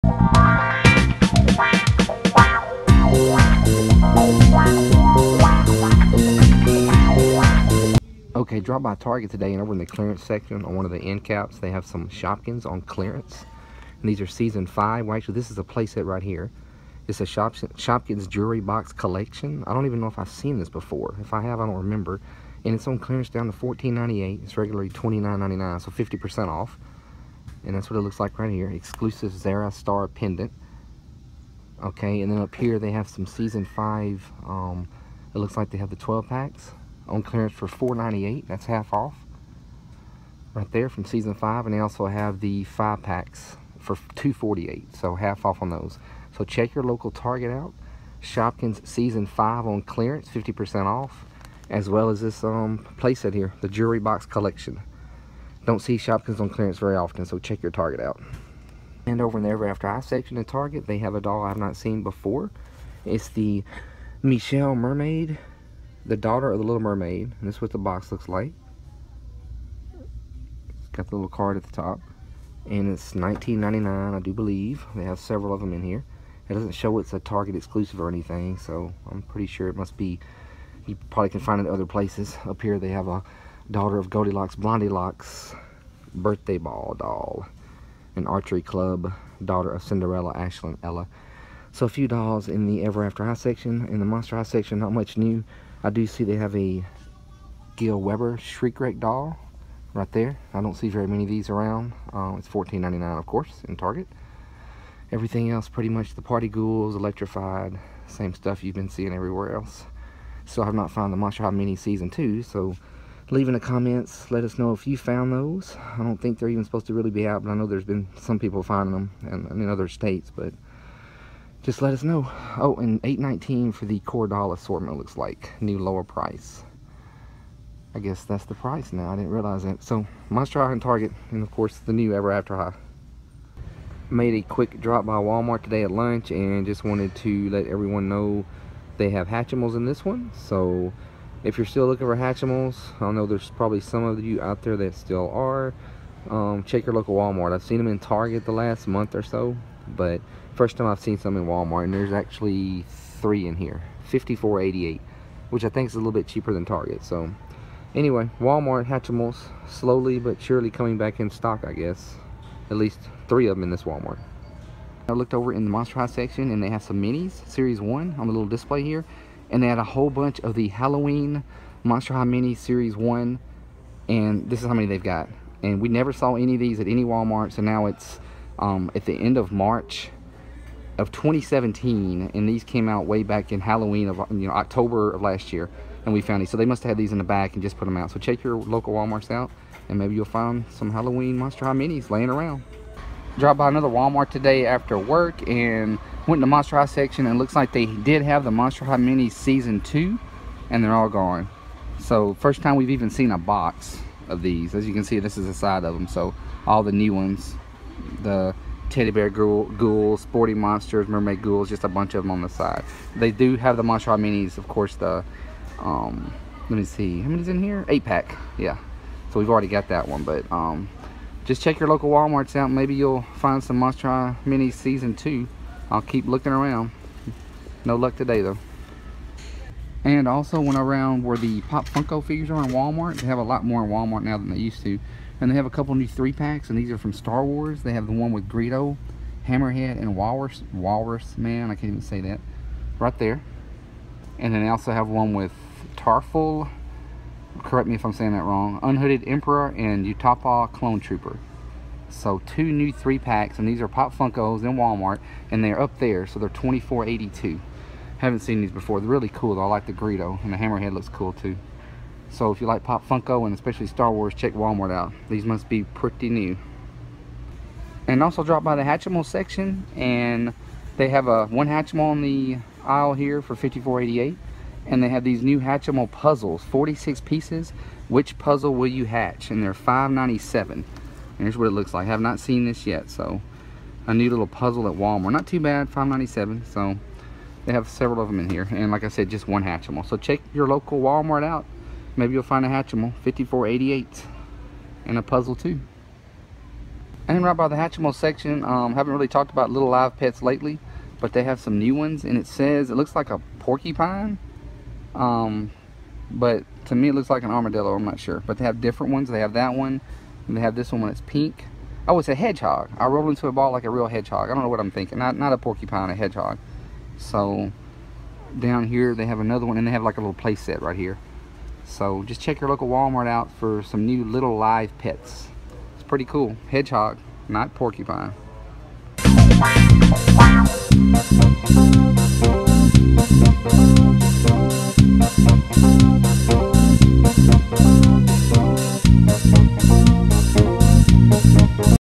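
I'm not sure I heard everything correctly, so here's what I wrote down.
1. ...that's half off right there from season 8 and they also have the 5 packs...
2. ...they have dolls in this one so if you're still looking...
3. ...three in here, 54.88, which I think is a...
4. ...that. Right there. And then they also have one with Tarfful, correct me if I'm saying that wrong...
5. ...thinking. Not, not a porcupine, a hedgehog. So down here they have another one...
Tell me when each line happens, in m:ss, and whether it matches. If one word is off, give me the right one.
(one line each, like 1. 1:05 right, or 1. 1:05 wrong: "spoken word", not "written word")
1. 0:38 wrong: "5", not "8"
2. 2:18 wrong: "hatchimals", not "dolls"
3. 2:33 right
4. 4:02 right
5. 5:14 right.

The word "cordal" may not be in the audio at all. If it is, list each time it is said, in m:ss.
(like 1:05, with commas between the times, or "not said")
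2:04.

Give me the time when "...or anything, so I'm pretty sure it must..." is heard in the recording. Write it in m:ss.
1:17.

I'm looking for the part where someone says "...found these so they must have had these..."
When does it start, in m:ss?
3:06.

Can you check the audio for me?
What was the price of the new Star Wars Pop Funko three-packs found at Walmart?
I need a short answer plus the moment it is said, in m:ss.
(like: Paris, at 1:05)
$24.82, at 4:16.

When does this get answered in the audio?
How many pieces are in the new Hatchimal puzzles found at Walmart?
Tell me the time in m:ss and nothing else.
4:36.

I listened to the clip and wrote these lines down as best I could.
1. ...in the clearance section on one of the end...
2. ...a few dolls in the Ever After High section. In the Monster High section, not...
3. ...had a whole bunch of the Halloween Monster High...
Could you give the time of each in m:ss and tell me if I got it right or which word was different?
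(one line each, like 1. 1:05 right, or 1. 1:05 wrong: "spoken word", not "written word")
1. 0:09 right
2. 1:31 right
3. 2:49 right.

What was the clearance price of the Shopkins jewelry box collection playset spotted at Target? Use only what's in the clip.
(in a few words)
$14.98.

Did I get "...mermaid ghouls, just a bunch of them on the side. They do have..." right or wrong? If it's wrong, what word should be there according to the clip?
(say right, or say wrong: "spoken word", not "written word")
right.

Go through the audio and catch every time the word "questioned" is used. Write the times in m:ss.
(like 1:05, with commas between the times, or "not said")
not said.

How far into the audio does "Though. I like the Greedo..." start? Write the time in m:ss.
4:19.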